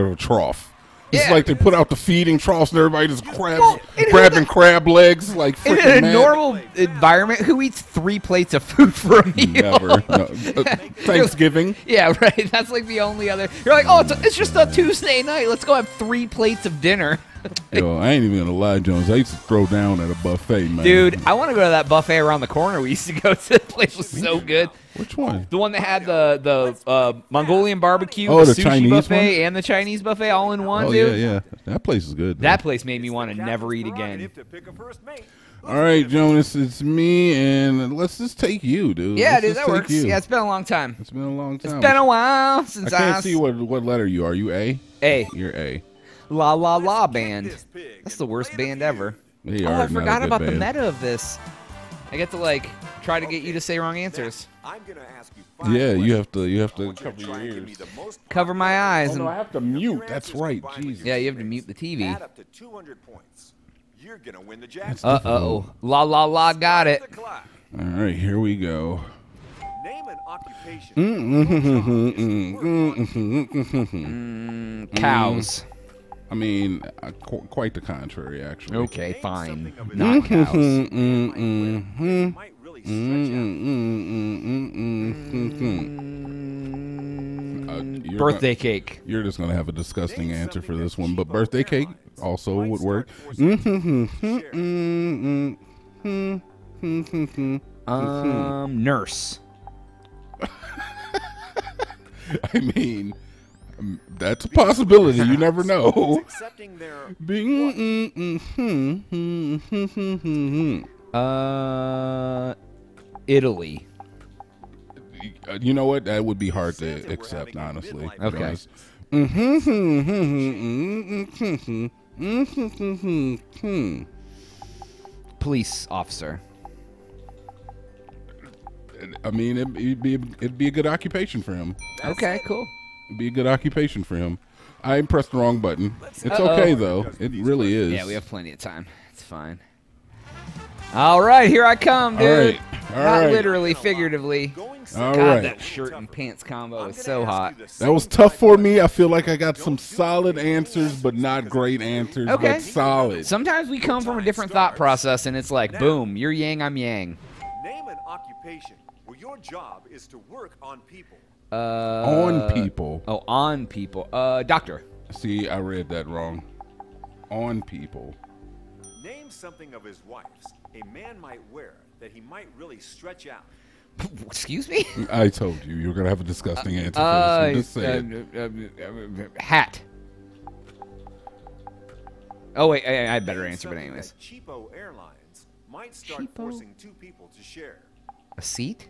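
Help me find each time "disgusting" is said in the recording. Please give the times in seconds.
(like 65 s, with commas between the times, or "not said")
89 s, 176 s.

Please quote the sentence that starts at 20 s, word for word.
Dude, I want to go to that buffet around the corner.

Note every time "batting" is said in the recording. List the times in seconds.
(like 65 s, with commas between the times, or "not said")
not said.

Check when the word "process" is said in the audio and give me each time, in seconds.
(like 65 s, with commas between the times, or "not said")
154 s.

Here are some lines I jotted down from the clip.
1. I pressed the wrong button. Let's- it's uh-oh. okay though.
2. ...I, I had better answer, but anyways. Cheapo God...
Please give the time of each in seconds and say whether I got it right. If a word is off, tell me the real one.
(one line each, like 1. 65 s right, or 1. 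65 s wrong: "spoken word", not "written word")
1. 134 s right
2. 182 s wrong: "Airlines", not "God".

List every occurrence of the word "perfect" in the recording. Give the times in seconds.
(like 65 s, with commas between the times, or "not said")
not said.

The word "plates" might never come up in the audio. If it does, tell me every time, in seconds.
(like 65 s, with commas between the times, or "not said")
8 s, 16 s.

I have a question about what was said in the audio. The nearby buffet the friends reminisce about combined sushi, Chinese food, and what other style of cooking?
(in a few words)
Mongolian barbecue.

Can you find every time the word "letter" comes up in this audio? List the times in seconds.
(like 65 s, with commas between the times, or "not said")
43 s.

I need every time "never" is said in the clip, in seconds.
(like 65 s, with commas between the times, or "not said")
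9 s, 33 s, 105 s.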